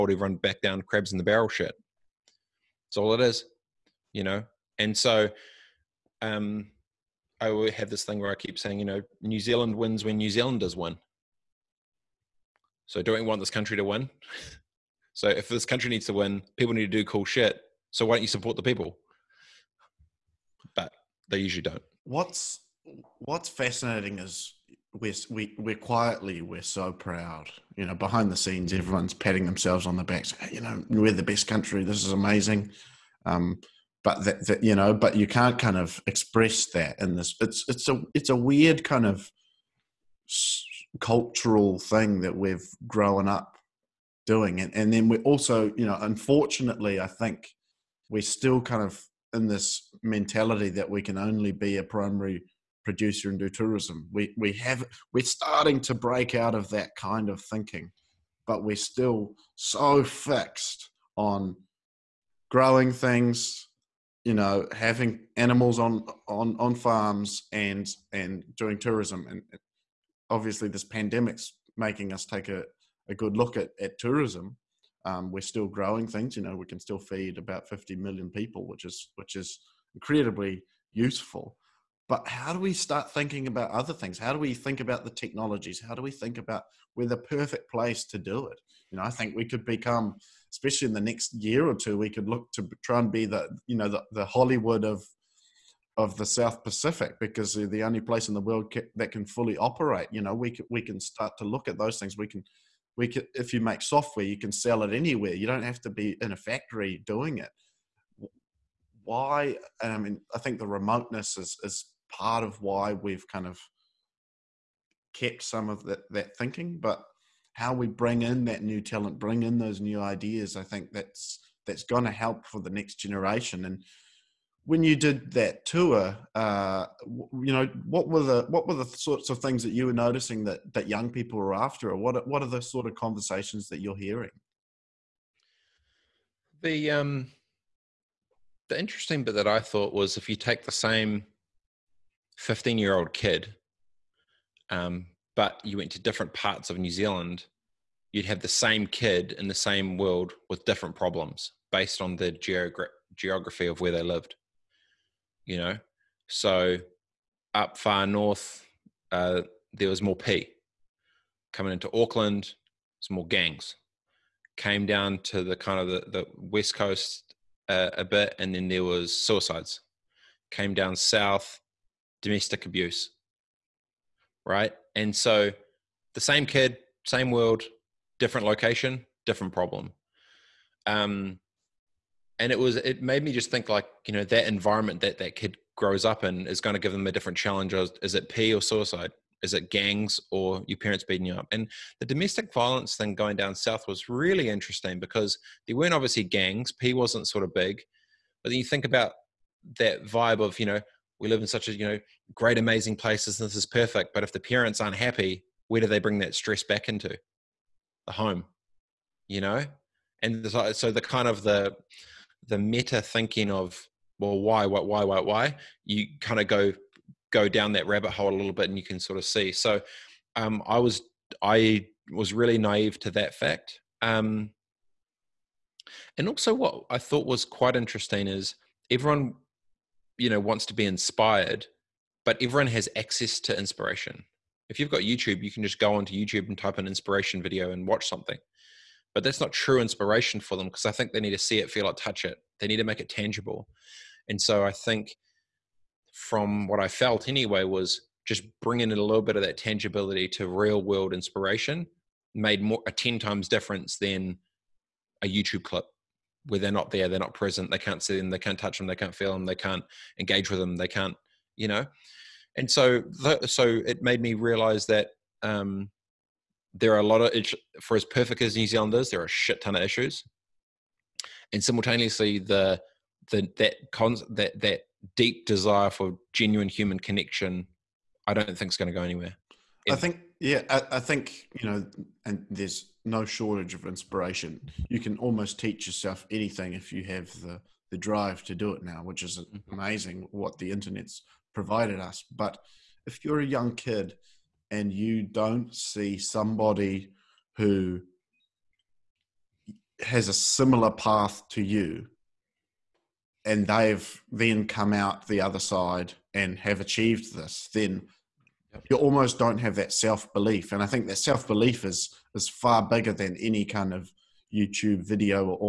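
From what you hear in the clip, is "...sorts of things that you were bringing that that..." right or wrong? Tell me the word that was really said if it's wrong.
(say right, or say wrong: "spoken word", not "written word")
wrong: "noticing", not "bringing".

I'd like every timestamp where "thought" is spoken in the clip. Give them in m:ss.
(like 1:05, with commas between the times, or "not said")
2:19, 3:46.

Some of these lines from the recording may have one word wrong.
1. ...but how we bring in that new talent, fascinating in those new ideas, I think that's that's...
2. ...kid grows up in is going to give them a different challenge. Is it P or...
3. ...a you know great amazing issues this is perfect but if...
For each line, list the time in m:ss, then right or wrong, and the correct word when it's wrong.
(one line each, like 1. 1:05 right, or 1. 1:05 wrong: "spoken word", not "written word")
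1. 1:56 wrong: "bring", not "fascinating"
2. 3:05 right
3. 3:21 wrong: "places", not "issues".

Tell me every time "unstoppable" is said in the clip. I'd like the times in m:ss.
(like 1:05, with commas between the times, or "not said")
not said.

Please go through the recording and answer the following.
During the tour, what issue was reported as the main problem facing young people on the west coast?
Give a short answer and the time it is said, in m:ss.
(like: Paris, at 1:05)
Suicides, at 2:49.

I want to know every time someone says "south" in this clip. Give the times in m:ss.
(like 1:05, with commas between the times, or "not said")
1:36, 2:50, 3:13.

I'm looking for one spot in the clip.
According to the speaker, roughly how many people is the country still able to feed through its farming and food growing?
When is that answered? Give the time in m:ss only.
1:17.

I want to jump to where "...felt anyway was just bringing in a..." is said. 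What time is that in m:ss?
4:06.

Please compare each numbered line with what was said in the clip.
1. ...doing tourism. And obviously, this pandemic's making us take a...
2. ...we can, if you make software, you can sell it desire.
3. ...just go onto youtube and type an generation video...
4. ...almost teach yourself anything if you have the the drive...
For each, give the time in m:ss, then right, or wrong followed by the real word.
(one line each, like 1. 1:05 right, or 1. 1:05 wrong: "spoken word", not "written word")
1. 1:08 right
2. 1:42 wrong: "anywhere", not "desire"
3. 3:55 wrong: "inspiration", not "generation"
4. 4:45 right.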